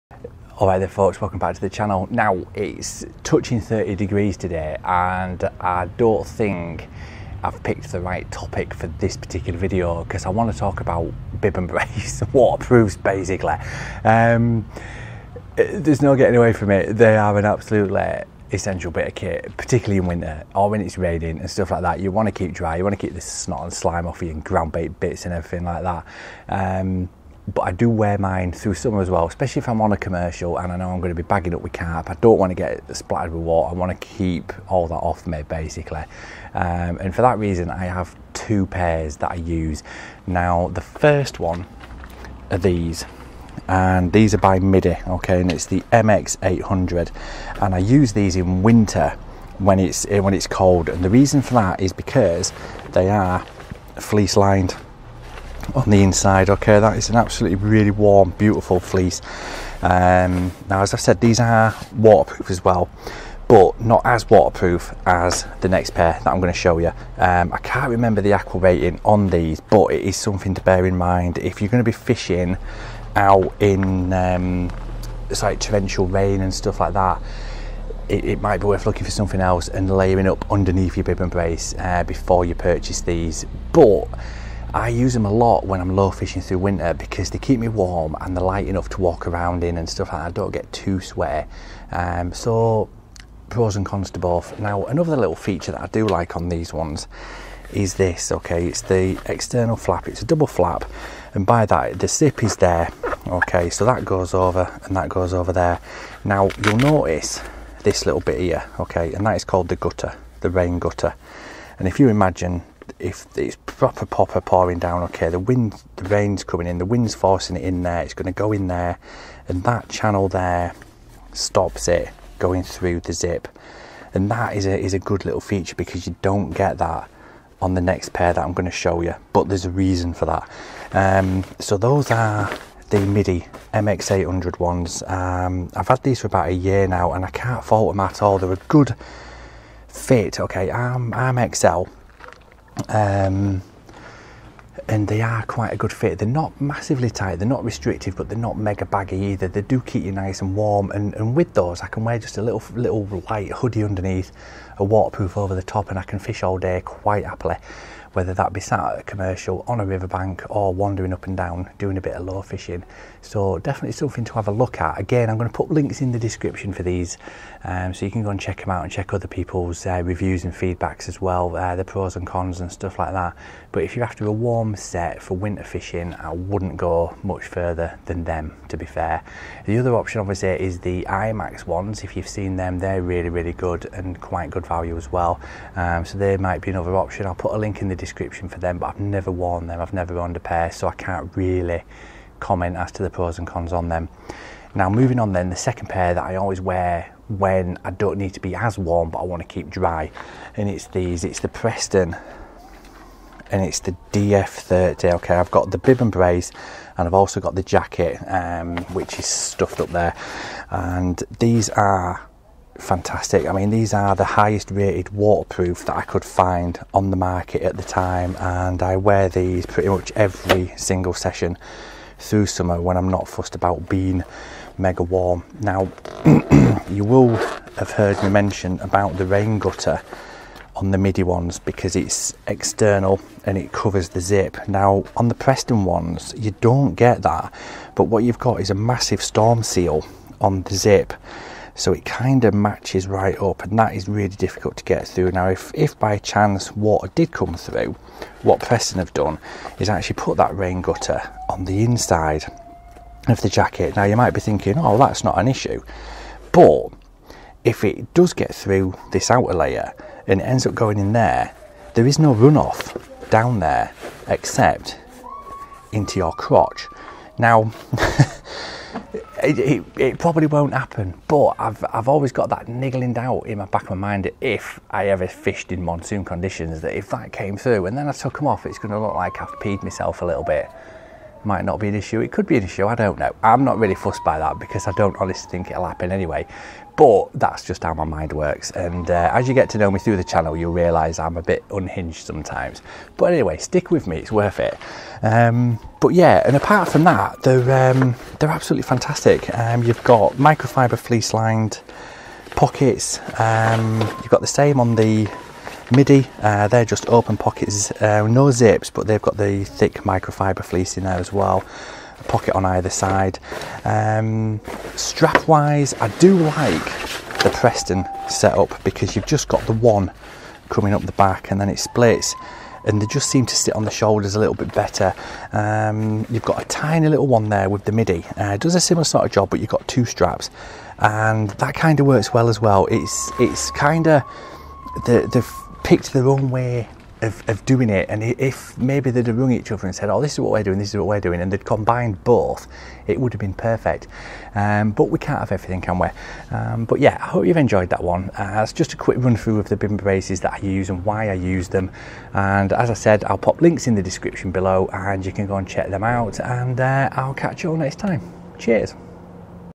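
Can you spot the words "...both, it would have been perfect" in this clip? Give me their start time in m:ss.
5:42.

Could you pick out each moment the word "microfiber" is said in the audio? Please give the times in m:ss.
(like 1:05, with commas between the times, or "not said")
5:00, 5:10.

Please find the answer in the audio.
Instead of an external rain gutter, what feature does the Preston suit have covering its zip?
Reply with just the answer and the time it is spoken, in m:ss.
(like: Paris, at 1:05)
storm seal, at 3:59.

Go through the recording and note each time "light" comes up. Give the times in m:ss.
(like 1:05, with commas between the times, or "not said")
1:28, 2:33.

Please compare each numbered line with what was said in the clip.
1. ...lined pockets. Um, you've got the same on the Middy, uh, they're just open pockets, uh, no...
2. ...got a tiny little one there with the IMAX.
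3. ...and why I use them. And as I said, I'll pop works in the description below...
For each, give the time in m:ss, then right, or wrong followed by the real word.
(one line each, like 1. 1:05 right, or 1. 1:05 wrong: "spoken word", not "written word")
1. 5:01 right
2. 5:26 wrong: "Middy", not "IMAX"
3. 5:50 wrong: "links", not "works".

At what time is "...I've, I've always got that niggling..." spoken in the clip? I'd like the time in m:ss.
4:31.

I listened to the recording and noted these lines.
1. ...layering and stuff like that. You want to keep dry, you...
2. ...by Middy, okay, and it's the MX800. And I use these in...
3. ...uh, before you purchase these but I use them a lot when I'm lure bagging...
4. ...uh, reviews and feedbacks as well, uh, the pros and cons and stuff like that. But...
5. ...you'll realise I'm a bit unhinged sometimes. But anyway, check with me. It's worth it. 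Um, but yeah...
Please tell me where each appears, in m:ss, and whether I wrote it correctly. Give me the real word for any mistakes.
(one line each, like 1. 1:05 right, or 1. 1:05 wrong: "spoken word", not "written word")
1. 0:20 wrong: "raining", not "layering"
2. 0:44 right
3. 1:21 wrong: "fishing", not "bagging"
4. 2:49 right
5. 4:50 wrong: "stick", not "check".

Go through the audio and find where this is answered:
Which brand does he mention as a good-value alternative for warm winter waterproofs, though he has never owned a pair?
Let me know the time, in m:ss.
3:01.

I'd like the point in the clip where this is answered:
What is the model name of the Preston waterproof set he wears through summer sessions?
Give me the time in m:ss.
3:24.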